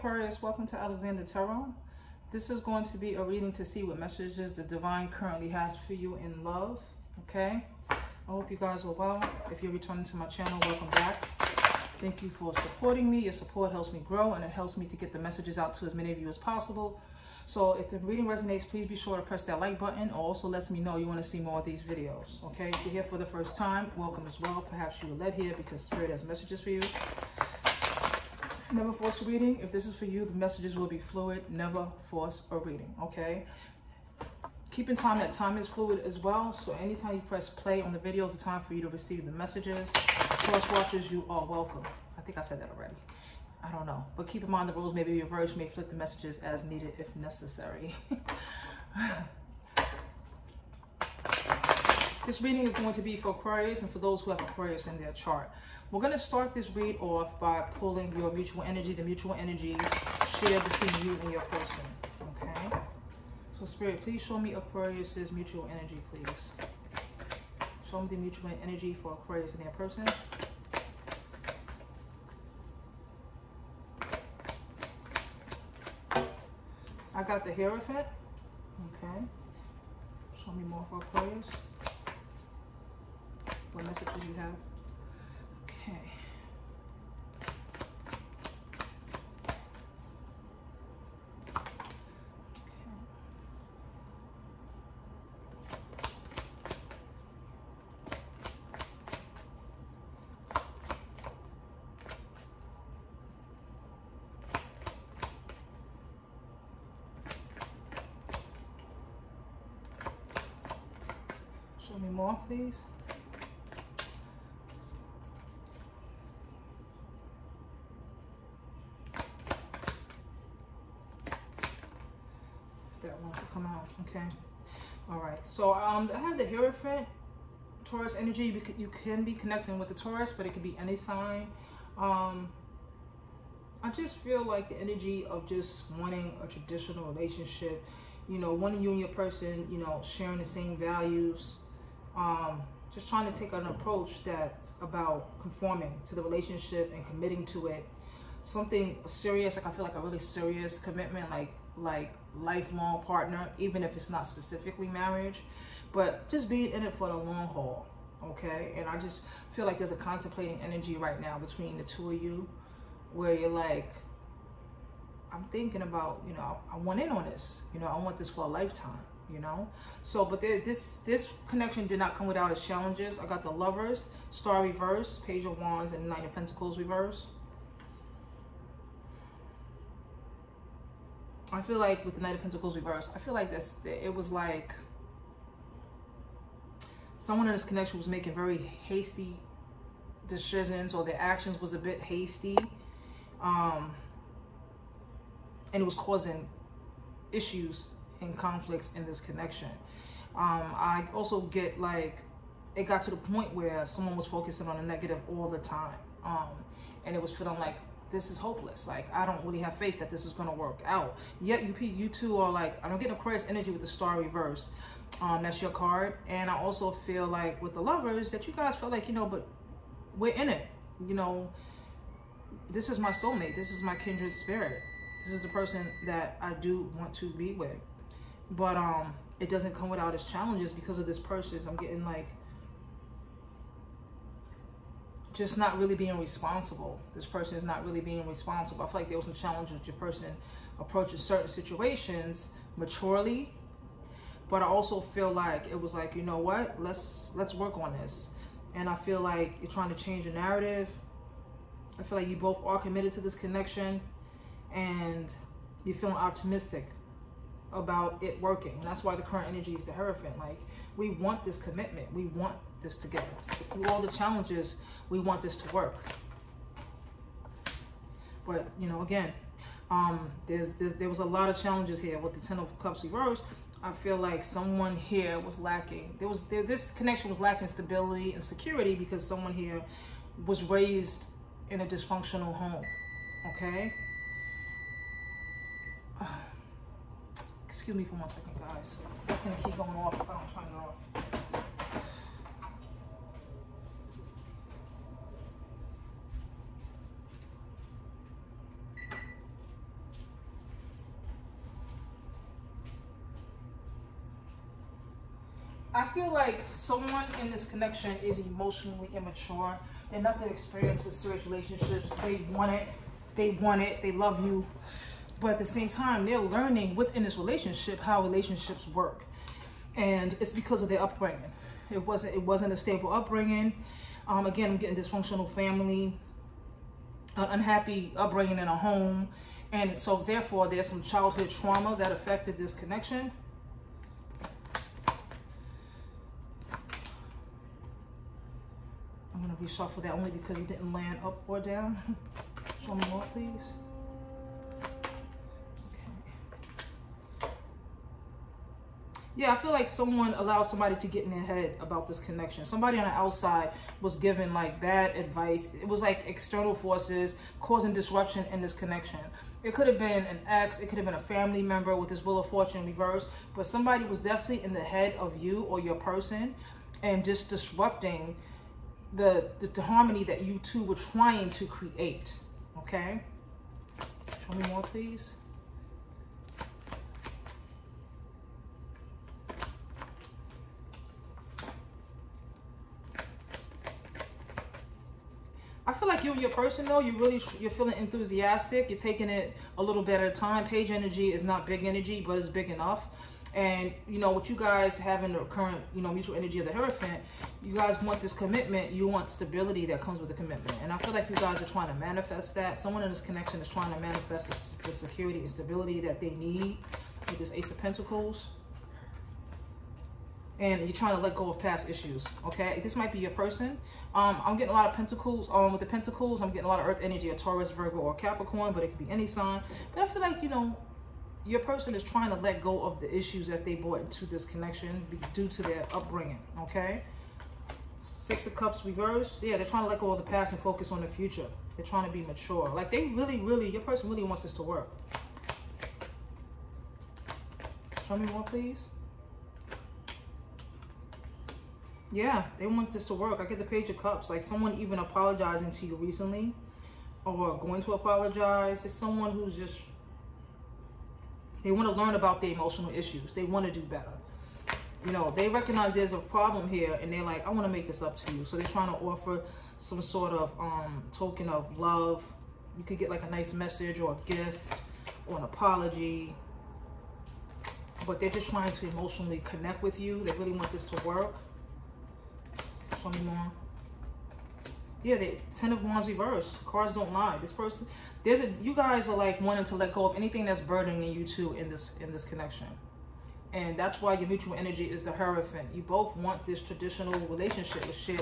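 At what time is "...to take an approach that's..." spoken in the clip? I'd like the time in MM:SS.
02:23.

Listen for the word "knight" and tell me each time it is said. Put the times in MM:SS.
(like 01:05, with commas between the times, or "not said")
02:56, 03:02.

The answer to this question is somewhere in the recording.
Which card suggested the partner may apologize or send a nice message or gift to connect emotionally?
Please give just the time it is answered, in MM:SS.
07:23.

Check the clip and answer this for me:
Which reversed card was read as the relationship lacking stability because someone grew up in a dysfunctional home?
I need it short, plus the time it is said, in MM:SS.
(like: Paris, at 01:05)
Ten of Cups, at 04:32.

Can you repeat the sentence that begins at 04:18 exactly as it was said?
That's why the current energy is the Hierophant.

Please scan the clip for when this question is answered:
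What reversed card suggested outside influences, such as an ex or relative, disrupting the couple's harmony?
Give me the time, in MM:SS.
06:02.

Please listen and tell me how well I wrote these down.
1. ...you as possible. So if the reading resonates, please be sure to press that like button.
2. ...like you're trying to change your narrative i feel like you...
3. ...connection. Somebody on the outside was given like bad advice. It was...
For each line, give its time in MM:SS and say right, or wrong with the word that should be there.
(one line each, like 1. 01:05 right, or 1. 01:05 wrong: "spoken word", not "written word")
1. 00:16 right
2. 04:09 right
3. 05:52 right.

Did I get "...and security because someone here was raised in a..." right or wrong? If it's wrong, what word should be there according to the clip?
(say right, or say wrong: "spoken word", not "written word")
right.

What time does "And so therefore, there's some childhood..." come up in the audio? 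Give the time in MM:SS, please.
05:29.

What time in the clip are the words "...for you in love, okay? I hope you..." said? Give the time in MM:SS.
00:05.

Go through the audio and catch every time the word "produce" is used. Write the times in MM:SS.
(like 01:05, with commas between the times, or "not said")
not said.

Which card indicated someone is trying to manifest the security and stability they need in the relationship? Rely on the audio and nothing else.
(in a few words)
Ace of Pentacles.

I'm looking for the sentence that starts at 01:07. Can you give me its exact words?
Show me the mutual energy for Aquarius and their person.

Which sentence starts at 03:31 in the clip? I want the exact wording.
Yet, you, you two are like, I don't get Aquarius energy with the star reverse.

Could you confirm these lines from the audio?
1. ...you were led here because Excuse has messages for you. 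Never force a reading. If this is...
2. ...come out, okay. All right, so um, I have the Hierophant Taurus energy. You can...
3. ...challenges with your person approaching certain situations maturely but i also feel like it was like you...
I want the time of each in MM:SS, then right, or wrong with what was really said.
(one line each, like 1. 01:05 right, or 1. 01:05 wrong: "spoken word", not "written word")
1. 00:25 wrong: "Spirit", not "Excuse"
2. 02:03 right
3. 03:59 right.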